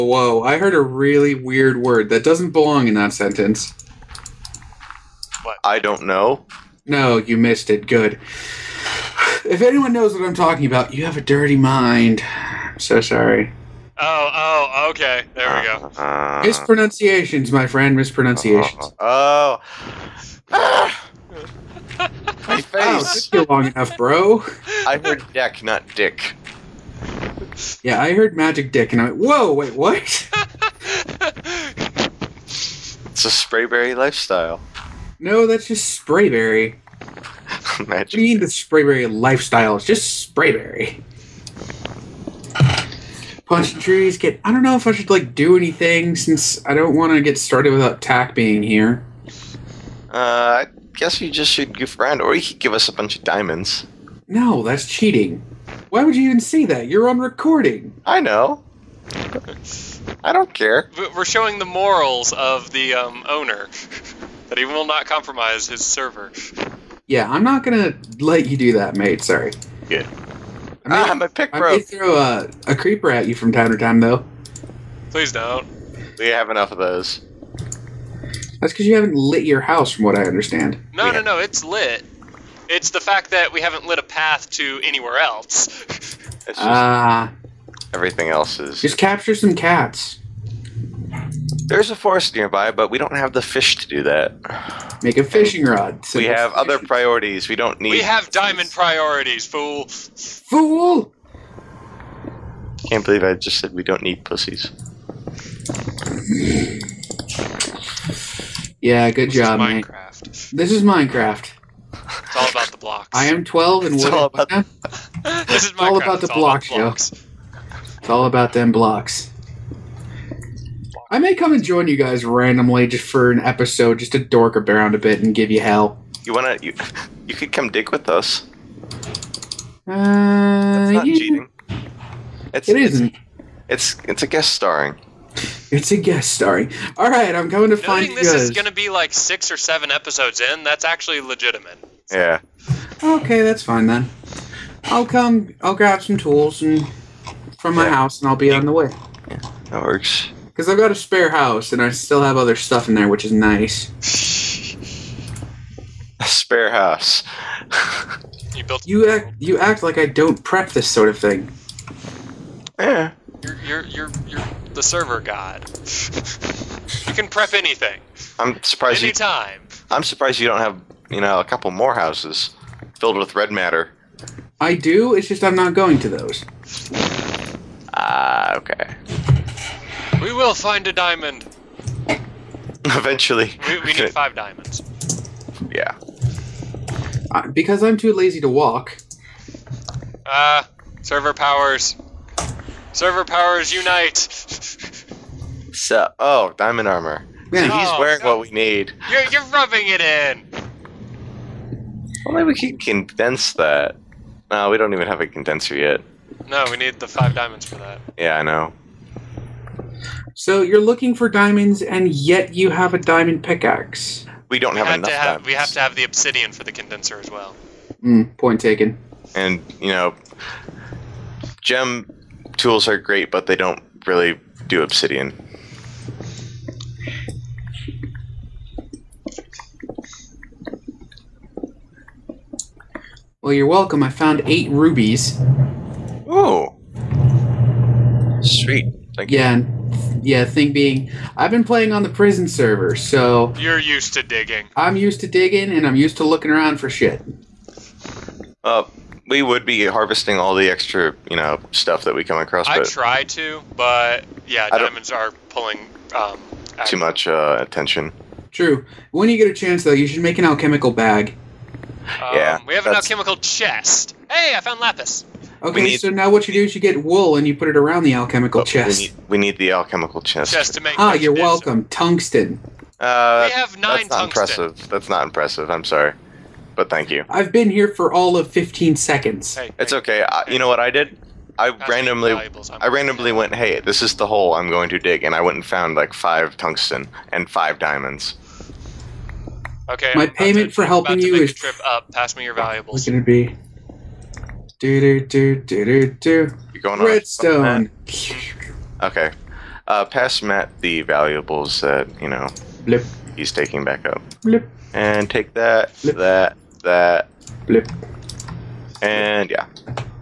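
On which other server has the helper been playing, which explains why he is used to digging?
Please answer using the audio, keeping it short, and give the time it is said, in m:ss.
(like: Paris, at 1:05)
The prison server, at 4:02.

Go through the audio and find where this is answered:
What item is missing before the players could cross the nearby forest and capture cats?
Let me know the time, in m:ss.
1:33.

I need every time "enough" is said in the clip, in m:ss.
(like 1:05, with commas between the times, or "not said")
0:23, 1:16, 3:34.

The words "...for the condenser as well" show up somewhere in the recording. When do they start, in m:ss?
3:36.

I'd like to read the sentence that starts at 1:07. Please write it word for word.
Yeah, I'm not gonna let you do that, mate.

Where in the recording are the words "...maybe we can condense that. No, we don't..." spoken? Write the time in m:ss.
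3:22.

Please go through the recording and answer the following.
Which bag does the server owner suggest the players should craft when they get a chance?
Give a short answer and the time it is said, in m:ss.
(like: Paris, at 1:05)
Alchemical bag, at 4:20.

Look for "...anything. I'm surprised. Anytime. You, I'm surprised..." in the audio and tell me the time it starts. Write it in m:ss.
2:47.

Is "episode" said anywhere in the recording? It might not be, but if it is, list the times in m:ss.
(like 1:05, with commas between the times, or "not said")
2:03, 2:19.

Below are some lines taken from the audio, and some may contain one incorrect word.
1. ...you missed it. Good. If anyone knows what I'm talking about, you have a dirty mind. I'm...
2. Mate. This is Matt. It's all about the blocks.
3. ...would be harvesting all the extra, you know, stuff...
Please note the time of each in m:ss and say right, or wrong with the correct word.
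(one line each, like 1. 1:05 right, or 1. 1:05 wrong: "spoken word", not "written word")
1. 0:07 right
2. 1:50 wrong: "Minecraft", not "Matt"
3. 4:09 right.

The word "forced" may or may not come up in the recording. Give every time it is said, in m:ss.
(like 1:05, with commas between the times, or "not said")
not said.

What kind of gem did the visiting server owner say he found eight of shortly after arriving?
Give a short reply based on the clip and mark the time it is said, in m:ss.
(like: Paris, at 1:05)
Rubies, at 3:54.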